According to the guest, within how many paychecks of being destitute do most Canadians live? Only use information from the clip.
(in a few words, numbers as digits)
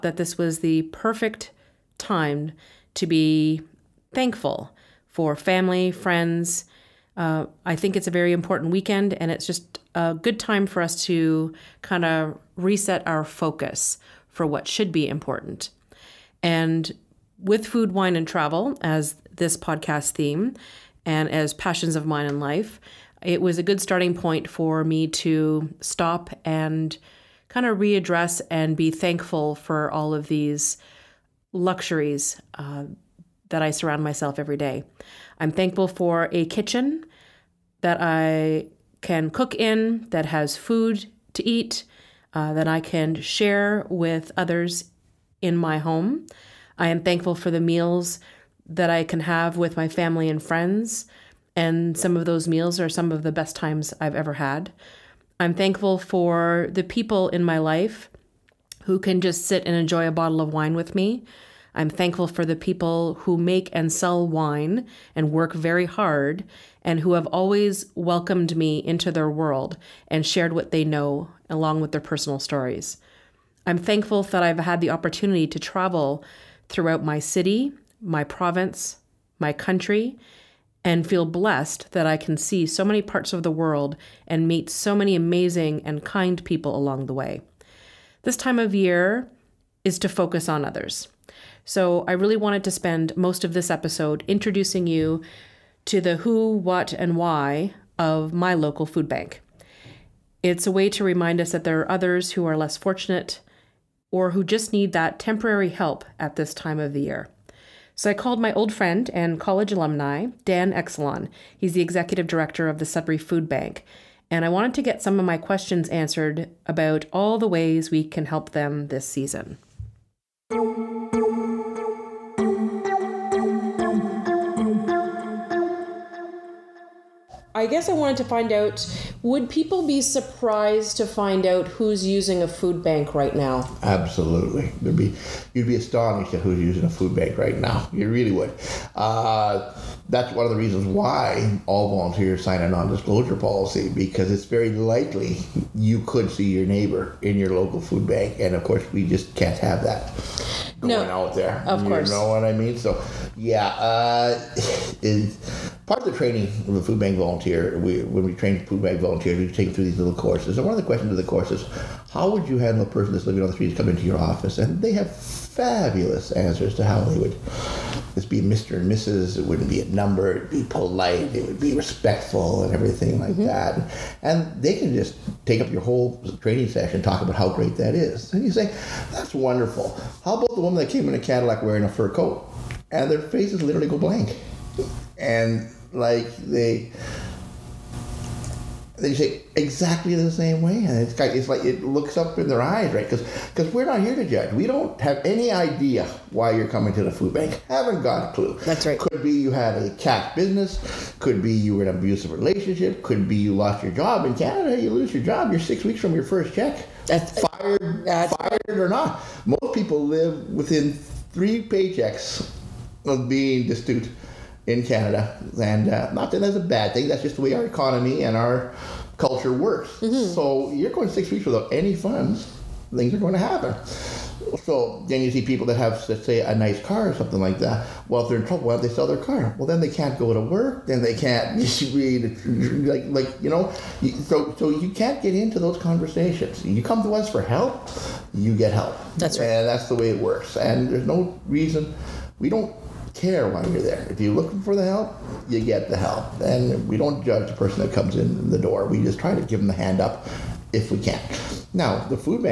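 3.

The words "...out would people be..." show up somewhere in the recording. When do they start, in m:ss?
2:08.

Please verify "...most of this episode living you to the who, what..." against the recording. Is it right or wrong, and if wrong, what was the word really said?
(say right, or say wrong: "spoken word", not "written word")
wrong: "introducing", not "living".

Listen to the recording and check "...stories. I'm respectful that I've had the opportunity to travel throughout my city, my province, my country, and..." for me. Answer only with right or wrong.
wrong.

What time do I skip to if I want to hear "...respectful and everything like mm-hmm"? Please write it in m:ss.
2:51.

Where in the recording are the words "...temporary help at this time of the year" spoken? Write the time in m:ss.
1:45.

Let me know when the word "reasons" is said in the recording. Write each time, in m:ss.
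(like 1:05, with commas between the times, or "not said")
2:20, 4:01.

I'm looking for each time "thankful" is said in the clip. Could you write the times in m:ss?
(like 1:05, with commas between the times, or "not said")
0:04, 0:28, 0:35, 0:47, 0:55, 1:01, 1:13.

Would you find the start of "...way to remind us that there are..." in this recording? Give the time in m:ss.
1:40.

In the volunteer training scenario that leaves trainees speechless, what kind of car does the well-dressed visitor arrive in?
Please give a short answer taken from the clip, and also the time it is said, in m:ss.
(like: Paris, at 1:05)
Cadillac, at 3:01.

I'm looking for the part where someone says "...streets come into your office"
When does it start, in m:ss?
2:43.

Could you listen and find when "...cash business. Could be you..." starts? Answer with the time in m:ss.
3:19.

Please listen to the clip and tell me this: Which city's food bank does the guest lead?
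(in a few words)
Sudbury.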